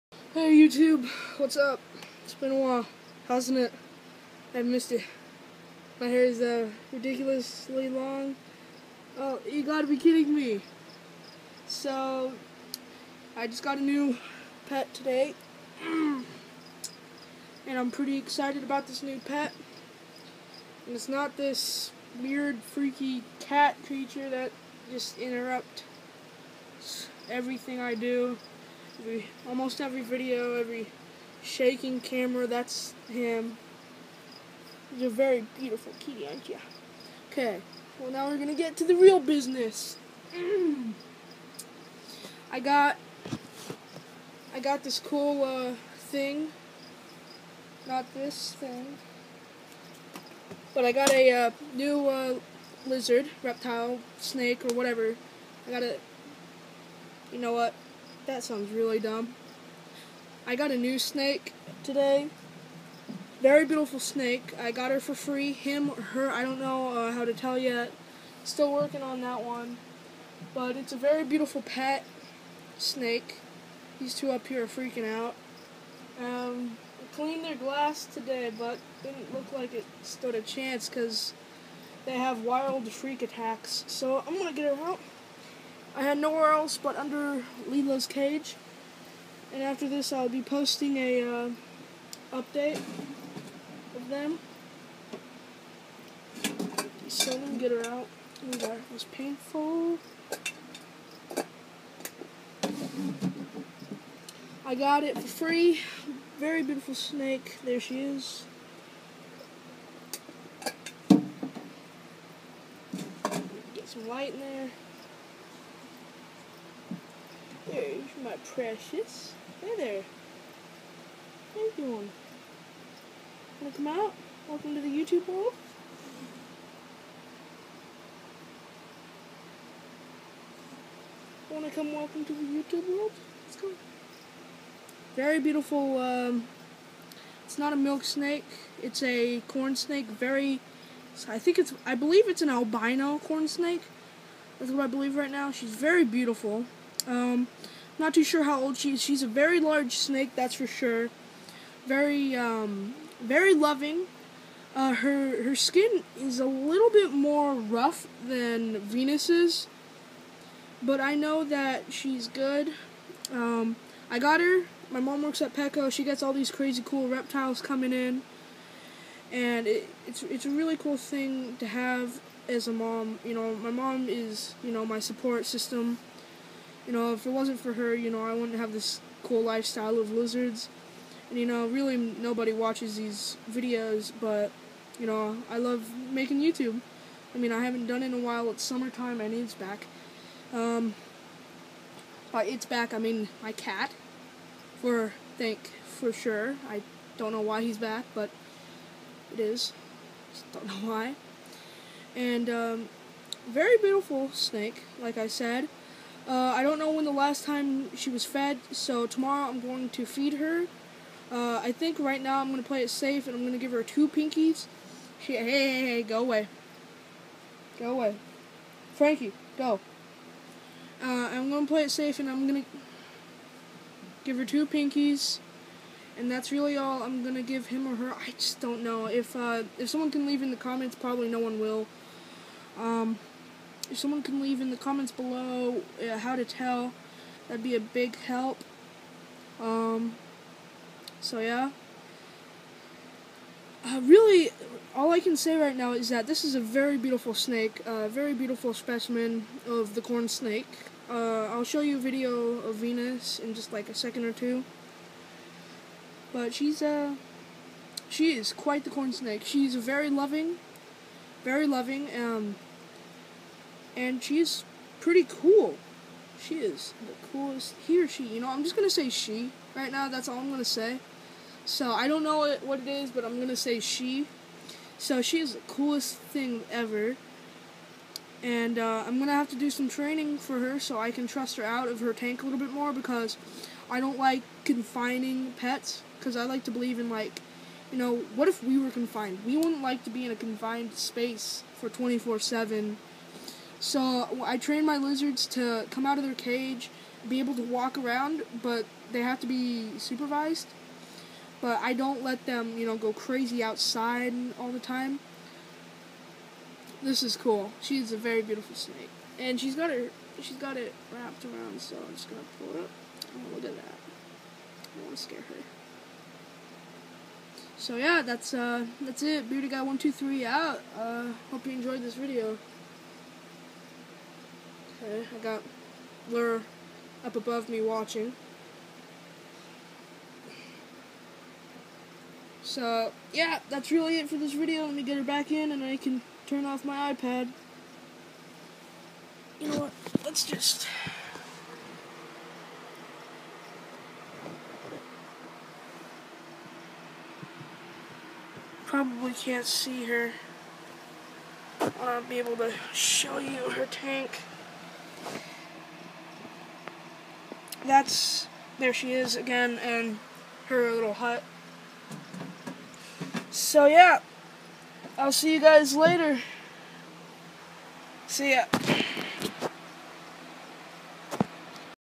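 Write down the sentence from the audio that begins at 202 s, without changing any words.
And, um, very beautiful snake, like I said.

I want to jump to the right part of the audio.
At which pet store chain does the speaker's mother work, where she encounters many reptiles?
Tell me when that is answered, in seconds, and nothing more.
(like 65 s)
165 s.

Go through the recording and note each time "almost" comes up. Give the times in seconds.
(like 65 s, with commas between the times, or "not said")
29 s.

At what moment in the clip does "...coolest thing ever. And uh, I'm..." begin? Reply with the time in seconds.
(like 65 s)
275 s.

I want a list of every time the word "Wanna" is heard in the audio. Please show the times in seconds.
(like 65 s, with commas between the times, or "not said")
123 s, 131 s.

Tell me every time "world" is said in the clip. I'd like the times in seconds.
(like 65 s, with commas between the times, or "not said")
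125 s, 132 s.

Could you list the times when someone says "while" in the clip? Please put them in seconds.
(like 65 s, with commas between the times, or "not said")
2 s, 188 s.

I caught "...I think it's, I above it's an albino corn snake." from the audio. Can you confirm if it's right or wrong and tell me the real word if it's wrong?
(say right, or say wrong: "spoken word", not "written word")
wrong: "believe", not "above".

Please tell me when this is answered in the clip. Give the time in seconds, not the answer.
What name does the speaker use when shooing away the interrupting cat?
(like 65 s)
218 s.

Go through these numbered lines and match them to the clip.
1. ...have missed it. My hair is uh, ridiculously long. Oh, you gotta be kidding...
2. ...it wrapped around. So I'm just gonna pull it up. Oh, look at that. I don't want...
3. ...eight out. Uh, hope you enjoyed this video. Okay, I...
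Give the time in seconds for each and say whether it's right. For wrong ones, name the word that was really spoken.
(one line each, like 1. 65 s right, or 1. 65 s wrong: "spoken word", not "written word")
1. 4 s right
2. 310 s right
3. 320 s wrong: "three", not "eight".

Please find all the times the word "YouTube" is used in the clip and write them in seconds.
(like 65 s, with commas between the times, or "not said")
0 s, 124 s, 132 s, 186 s.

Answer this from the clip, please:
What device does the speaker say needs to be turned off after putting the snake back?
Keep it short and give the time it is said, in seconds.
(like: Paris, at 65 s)
iPad, at 337 s.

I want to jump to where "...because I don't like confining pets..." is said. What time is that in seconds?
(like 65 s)
282 s.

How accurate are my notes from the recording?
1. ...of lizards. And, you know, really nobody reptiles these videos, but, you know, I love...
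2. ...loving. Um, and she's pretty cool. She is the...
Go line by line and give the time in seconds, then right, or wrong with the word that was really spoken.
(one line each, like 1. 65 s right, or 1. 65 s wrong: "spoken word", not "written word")
1. 179 s wrong: "watches", not "reptiles"
2. 261 s right.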